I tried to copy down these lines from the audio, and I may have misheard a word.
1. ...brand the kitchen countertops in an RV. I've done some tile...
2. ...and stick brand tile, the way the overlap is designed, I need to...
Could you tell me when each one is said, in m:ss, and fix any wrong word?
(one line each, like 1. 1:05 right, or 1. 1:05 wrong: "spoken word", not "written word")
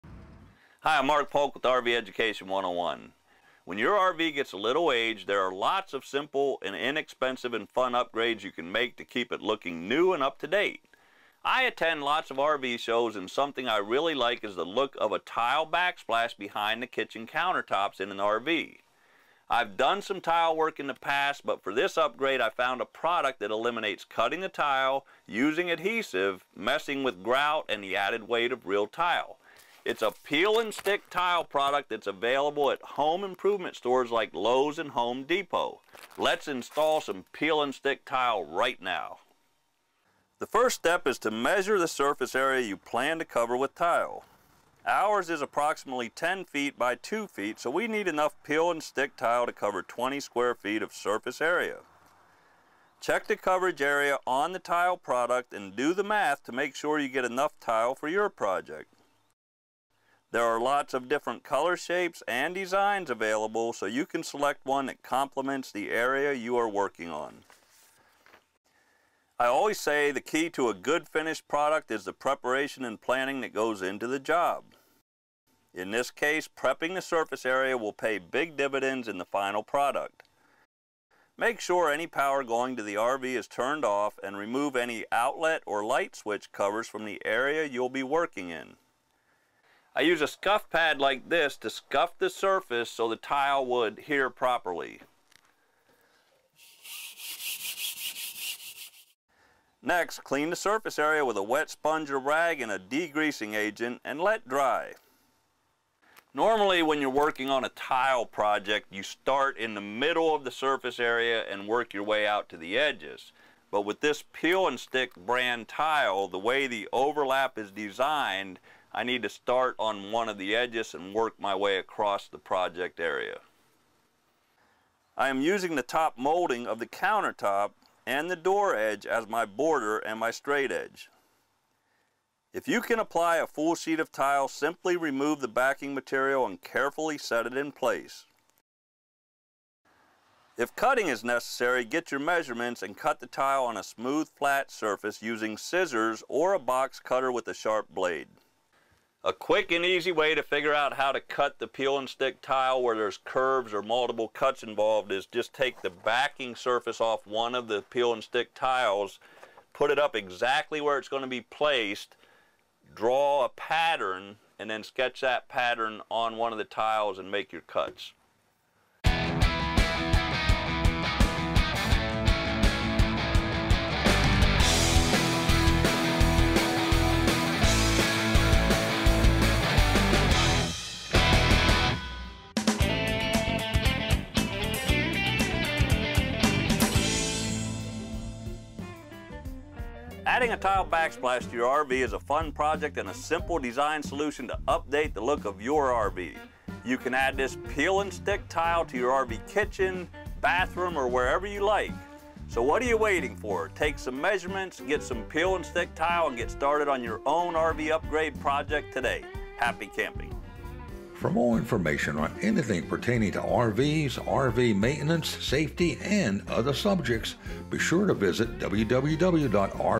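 1. 0:16 wrong: "behind", not "brand"
2. 1:54 right.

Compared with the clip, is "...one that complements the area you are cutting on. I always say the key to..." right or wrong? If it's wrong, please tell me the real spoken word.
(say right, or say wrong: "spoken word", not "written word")
wrong: "working", not "cutting".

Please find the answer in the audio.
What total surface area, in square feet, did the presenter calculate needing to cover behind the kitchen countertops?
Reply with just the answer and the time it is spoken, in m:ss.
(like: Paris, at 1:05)
20 square feet, at 0:49.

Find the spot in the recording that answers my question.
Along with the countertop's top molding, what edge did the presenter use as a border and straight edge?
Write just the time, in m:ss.
2:08.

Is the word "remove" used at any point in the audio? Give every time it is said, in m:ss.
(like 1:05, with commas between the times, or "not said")
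1:24, 2:14.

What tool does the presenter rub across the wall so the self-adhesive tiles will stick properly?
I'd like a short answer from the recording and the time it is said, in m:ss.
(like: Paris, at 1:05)
scuff pad, at 1:30.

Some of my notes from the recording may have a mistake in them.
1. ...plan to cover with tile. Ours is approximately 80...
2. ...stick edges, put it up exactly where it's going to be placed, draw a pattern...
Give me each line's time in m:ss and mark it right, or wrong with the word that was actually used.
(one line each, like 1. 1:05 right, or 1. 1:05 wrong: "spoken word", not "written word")
1. 0:42 wrong: "10", not "80"
2. 2:38 wrong: "tiles", not "edges".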